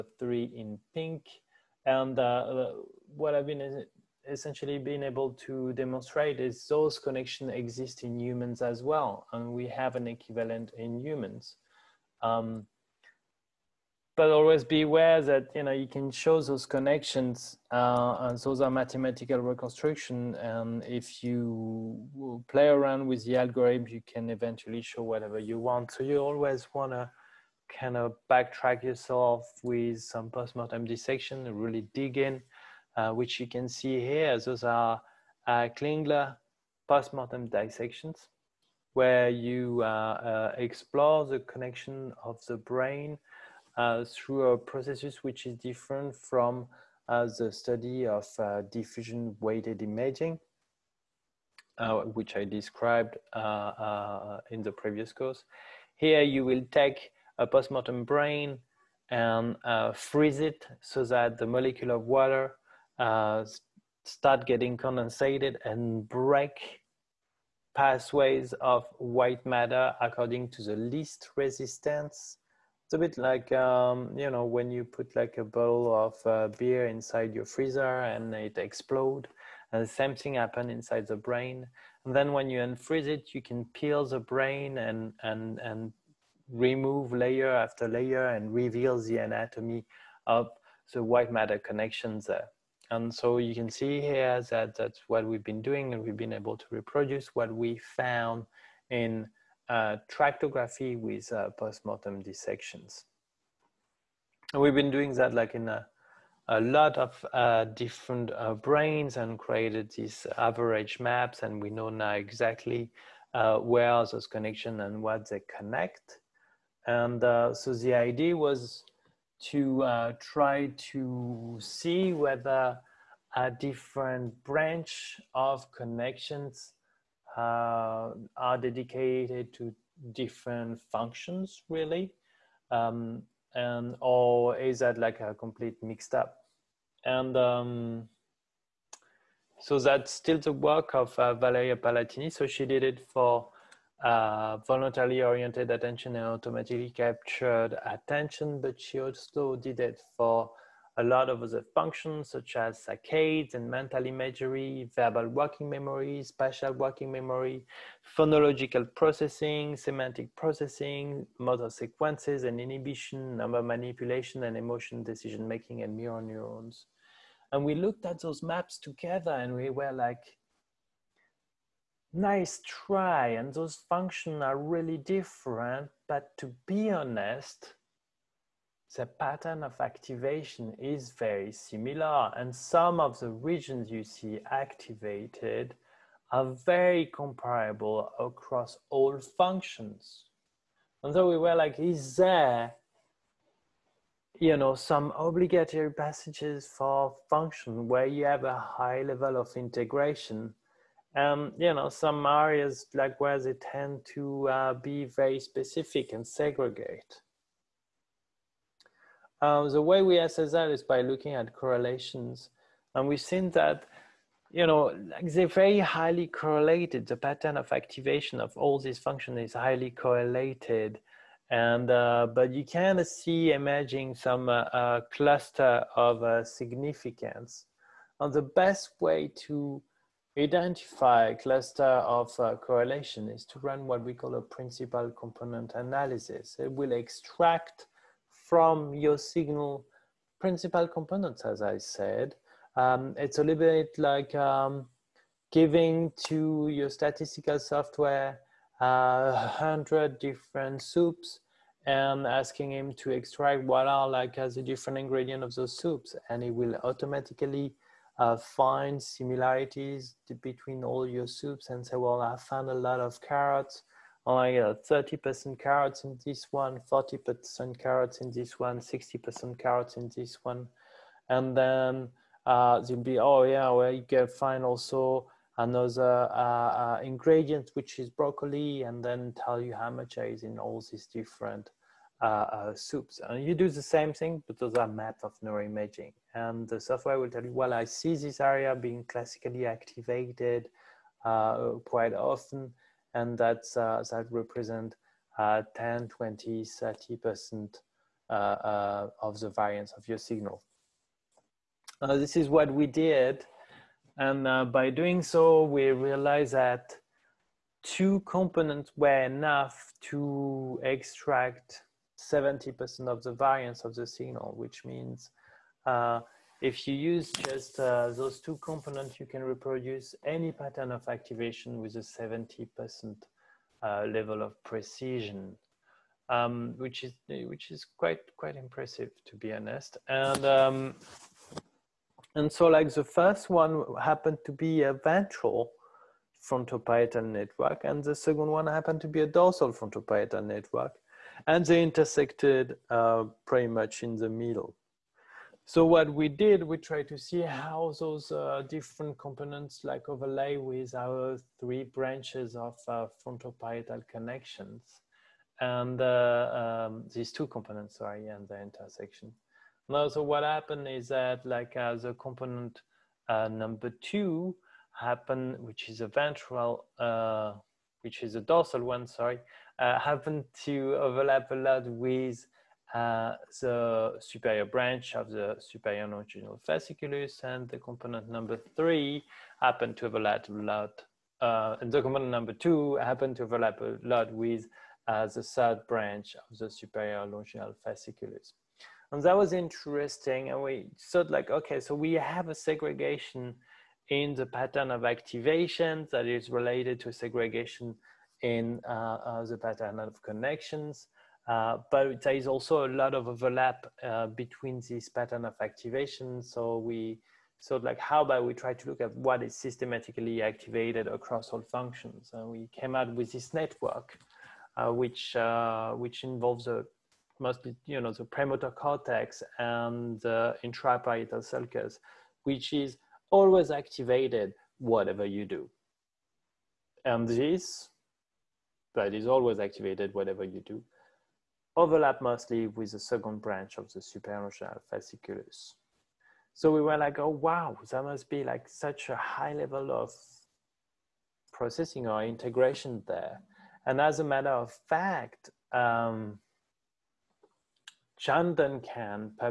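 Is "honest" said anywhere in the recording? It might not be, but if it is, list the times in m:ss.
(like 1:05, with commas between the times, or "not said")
2:56, 5:29.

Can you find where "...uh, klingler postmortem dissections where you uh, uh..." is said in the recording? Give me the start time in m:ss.
0:35.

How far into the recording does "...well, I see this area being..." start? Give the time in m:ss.
4:47.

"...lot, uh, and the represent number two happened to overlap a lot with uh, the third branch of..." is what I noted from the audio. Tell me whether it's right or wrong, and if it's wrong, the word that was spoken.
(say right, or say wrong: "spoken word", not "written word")
wrong: "component", not "represent".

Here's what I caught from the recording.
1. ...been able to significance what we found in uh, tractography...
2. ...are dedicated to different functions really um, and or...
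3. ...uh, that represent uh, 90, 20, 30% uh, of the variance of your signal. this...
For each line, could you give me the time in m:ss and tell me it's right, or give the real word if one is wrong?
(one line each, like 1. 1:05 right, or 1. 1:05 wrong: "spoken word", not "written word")
1. 1:36 wrong: "reproduce", not "significance"
2. 2:08 right
3. 4:53 wrong: "10", not "90".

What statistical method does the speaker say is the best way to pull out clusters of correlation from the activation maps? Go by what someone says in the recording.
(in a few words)
Principal component analysis.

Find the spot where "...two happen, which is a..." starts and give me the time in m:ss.
6:03.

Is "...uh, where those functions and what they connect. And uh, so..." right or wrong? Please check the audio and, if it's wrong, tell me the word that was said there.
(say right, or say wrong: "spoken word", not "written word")
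wrong: "connections", not "functions".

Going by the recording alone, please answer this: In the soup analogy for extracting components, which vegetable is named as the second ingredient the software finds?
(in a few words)
Broccoli.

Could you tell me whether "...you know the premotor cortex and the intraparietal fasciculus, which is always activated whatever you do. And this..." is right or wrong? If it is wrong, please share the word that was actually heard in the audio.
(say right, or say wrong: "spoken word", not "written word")
wrong: "sulcus", not "fasciculus".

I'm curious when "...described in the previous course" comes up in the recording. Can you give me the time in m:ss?
0:52.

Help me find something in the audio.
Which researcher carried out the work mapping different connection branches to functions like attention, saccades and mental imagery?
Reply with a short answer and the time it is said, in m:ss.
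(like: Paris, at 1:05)
Valeria Parlatini, at 2:21.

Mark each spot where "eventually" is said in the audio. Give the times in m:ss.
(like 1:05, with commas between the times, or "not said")
0:24.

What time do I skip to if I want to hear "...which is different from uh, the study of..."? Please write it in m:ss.
0:45.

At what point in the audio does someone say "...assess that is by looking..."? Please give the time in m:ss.
3:30.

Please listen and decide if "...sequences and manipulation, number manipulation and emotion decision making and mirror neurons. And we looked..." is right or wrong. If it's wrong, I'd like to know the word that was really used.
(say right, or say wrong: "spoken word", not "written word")
wrong: "inhibition", not "manipulation".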